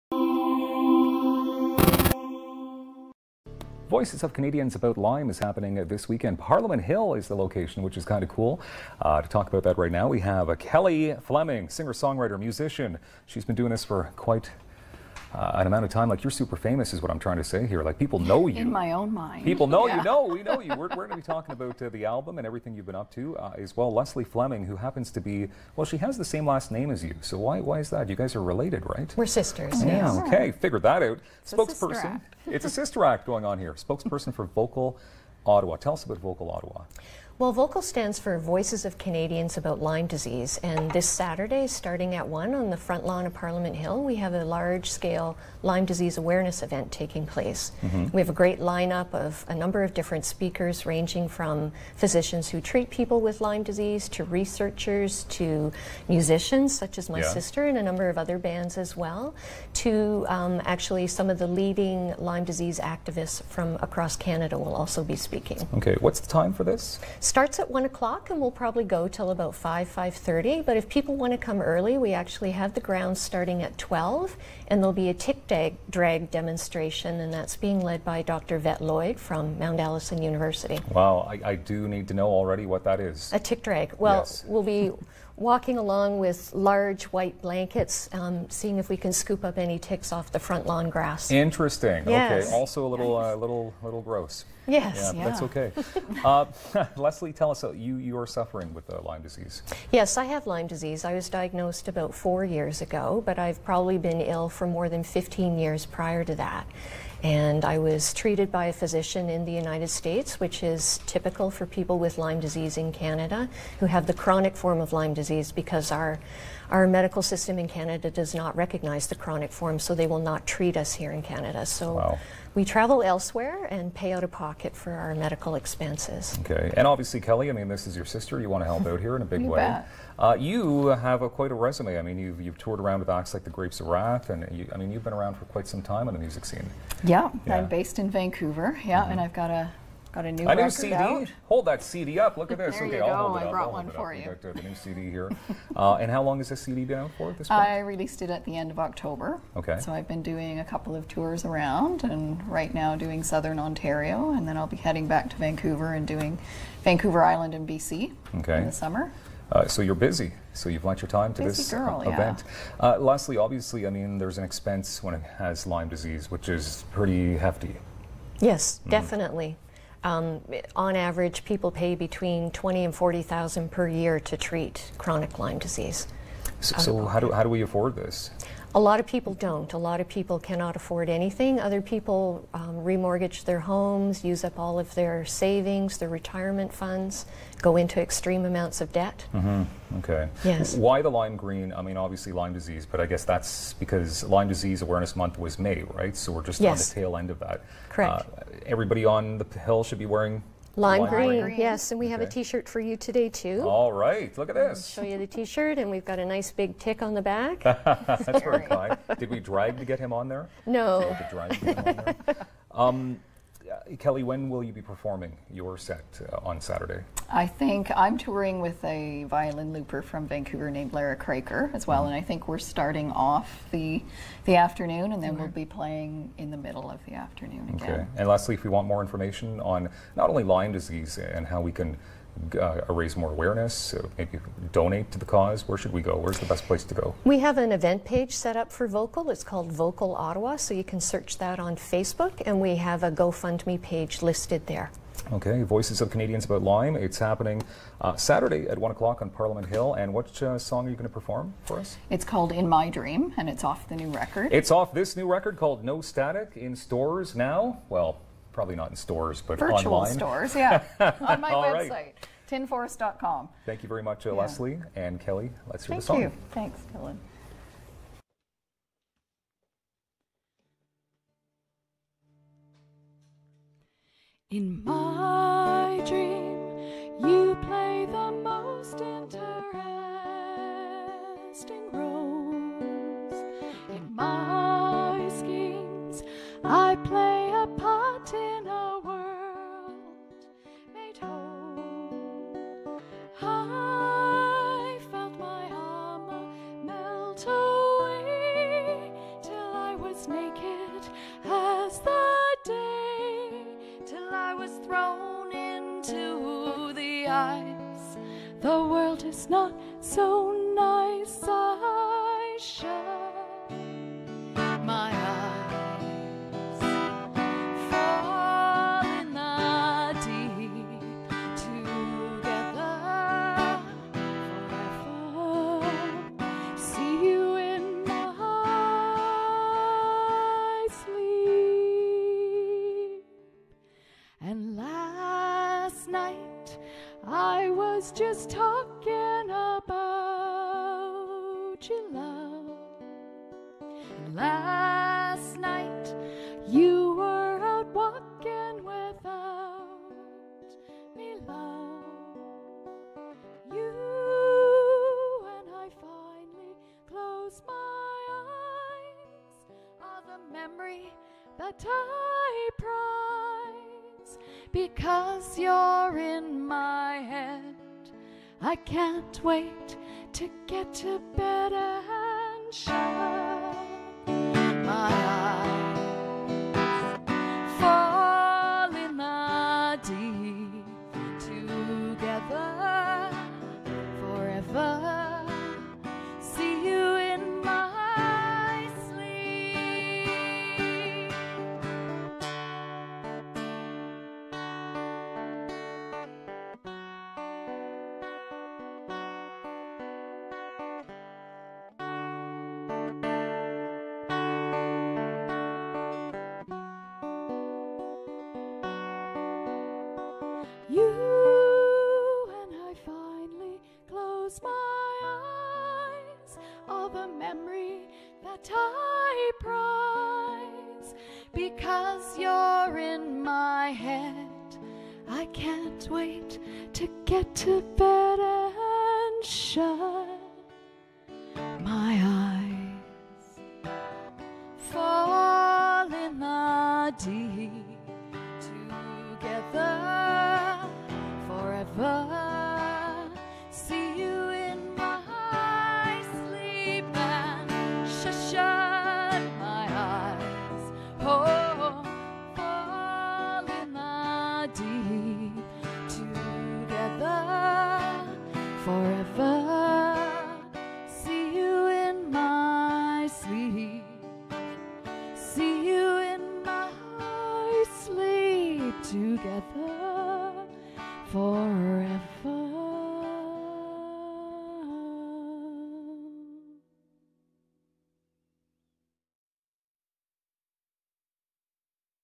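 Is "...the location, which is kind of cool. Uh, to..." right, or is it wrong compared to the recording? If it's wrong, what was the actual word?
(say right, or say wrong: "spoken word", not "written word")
right.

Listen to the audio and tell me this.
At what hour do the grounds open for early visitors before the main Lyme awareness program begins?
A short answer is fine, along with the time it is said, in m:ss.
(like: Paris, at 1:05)
12, at 1:13.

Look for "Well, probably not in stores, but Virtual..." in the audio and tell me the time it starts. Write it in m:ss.
4:17.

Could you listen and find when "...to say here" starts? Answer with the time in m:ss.
0:17.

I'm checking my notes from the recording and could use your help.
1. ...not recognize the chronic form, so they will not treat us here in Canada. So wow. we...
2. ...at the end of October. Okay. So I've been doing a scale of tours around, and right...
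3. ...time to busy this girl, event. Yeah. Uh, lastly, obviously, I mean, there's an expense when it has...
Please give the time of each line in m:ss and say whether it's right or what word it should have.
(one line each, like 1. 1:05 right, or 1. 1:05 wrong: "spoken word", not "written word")
1. 1:58 right
2. 2:28 wrong: "couple", not "scale"
3. 2:41 right.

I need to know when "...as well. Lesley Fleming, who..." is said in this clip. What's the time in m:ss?
0:23.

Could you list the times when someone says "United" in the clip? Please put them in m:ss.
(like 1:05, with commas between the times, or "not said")
1:49.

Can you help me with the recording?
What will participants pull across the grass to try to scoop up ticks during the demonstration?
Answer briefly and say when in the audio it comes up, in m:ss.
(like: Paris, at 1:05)
large white blankets, at 1:26.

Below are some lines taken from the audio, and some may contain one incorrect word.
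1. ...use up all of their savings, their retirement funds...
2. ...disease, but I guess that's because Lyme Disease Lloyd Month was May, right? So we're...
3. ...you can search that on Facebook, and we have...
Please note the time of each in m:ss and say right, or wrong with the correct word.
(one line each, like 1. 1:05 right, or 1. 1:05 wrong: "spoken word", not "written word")
1. 3:04 right
2. 3:12 wrong: "Awareness", not "Lloyd"
3. 4:00 right.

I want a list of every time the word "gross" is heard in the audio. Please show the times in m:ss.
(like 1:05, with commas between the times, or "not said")
1:34.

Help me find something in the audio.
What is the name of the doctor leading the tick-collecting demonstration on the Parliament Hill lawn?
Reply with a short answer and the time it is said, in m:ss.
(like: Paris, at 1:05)
Dr. Vett Lloyd, at 1:18.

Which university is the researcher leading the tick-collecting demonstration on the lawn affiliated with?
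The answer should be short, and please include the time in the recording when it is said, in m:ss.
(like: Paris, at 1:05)
Mount Allison University, at 1:19.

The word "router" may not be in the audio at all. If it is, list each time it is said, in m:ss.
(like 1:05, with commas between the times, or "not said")
not said.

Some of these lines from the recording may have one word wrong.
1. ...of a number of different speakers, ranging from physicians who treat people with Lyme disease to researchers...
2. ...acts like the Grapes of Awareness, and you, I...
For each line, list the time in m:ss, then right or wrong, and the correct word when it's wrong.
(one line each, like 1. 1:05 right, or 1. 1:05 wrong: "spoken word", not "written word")
1. 0:49 right
2. 2:13 wrong: "Wrath", not "Awareness".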